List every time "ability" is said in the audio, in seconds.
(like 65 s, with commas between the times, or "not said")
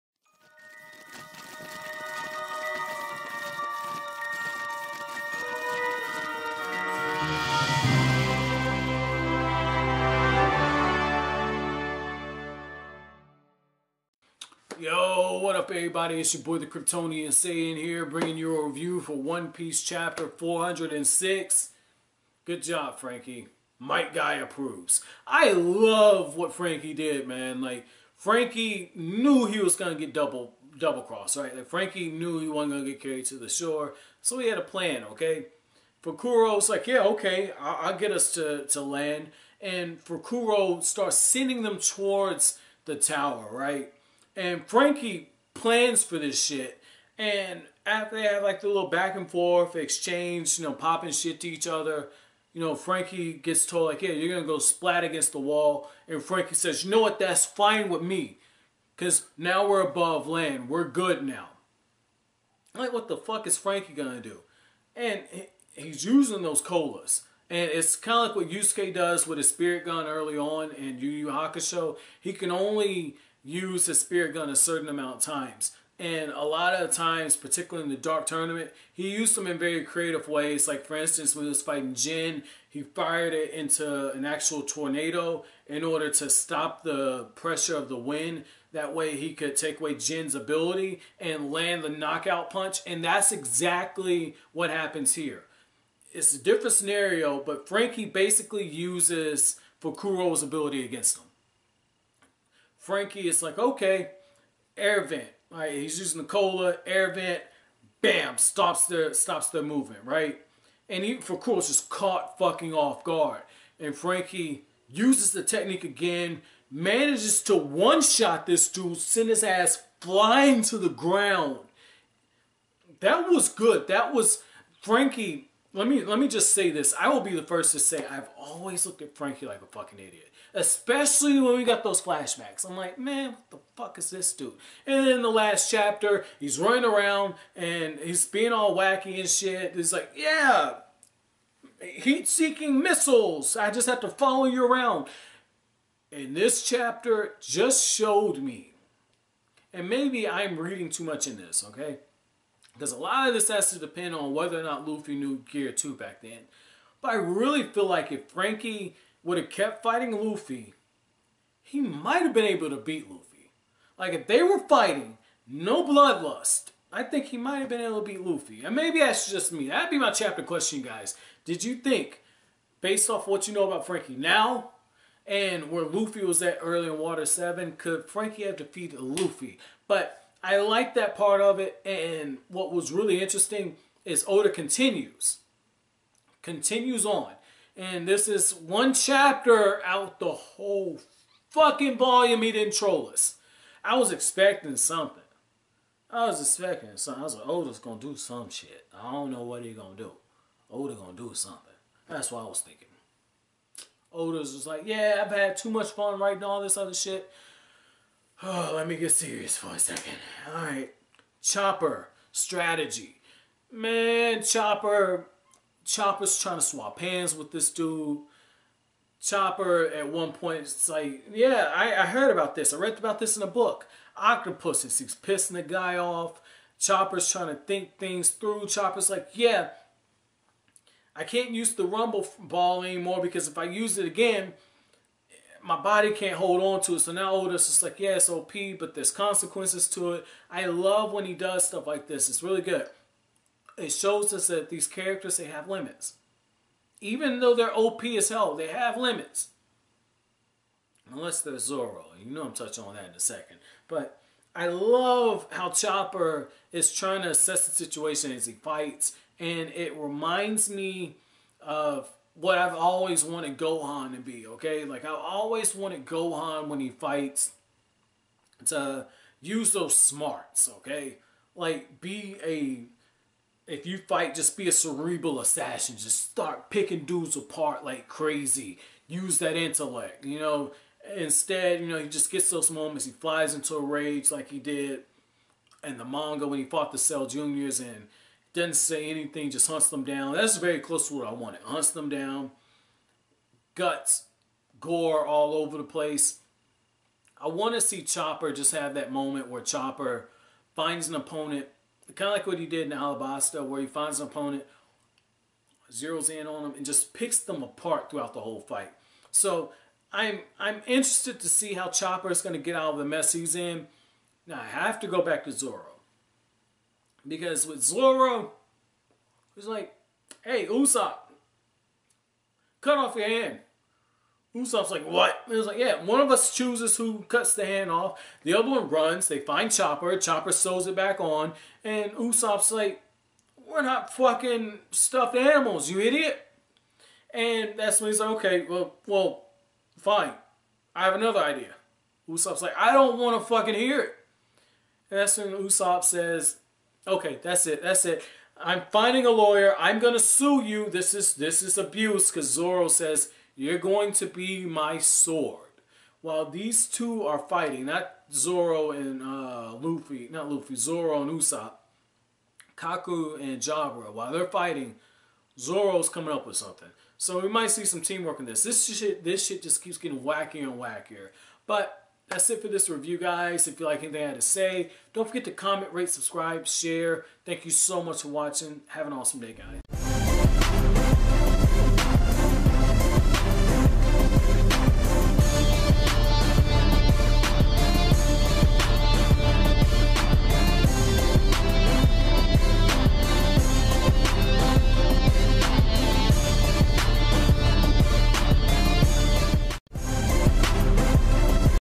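90 s, 100 s.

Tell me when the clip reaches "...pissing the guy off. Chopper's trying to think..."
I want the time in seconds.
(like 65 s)
225 s.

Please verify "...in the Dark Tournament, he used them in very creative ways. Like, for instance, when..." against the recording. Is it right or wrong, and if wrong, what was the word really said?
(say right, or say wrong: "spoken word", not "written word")
right.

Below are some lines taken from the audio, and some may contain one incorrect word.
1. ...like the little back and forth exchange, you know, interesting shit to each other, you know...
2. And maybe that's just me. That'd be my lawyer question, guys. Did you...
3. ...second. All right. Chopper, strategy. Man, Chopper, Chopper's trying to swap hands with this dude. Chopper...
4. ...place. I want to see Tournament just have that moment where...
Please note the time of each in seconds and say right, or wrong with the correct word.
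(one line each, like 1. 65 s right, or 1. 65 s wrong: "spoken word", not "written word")
1. 48 s wrong: "popping", not "interesting"
2. 168 s wrong: "chapter", not "lawyer"
3. 209 s right
4. 295 s wrong: "Chopper", not "Tournament".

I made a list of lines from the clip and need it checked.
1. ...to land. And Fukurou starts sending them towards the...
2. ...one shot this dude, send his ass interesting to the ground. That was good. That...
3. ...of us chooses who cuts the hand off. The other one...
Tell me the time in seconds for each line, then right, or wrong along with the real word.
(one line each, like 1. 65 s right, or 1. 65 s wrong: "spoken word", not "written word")
1. 38 s right
2. 117 s wrong: "flying", not "interesting"
3. 326 s right.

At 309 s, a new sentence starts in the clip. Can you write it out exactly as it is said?
So I'm I'm interested to see how Chopper is going to get out of the mess he's in.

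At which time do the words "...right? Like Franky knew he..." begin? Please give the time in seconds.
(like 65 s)
31 s.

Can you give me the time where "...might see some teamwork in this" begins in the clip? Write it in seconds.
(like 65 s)
367 s.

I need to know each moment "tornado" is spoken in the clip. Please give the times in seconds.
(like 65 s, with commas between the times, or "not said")
84 s.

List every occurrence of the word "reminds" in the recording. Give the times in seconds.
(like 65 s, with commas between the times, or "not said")
259 s.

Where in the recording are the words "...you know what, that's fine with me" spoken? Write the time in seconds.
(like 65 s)
56 s.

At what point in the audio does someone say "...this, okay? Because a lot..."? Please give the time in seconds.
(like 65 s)
151 s.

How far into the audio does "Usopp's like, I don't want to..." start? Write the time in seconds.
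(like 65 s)
342 s.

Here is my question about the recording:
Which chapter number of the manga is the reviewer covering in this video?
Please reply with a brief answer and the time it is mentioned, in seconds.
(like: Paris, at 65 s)
406, at 19 s.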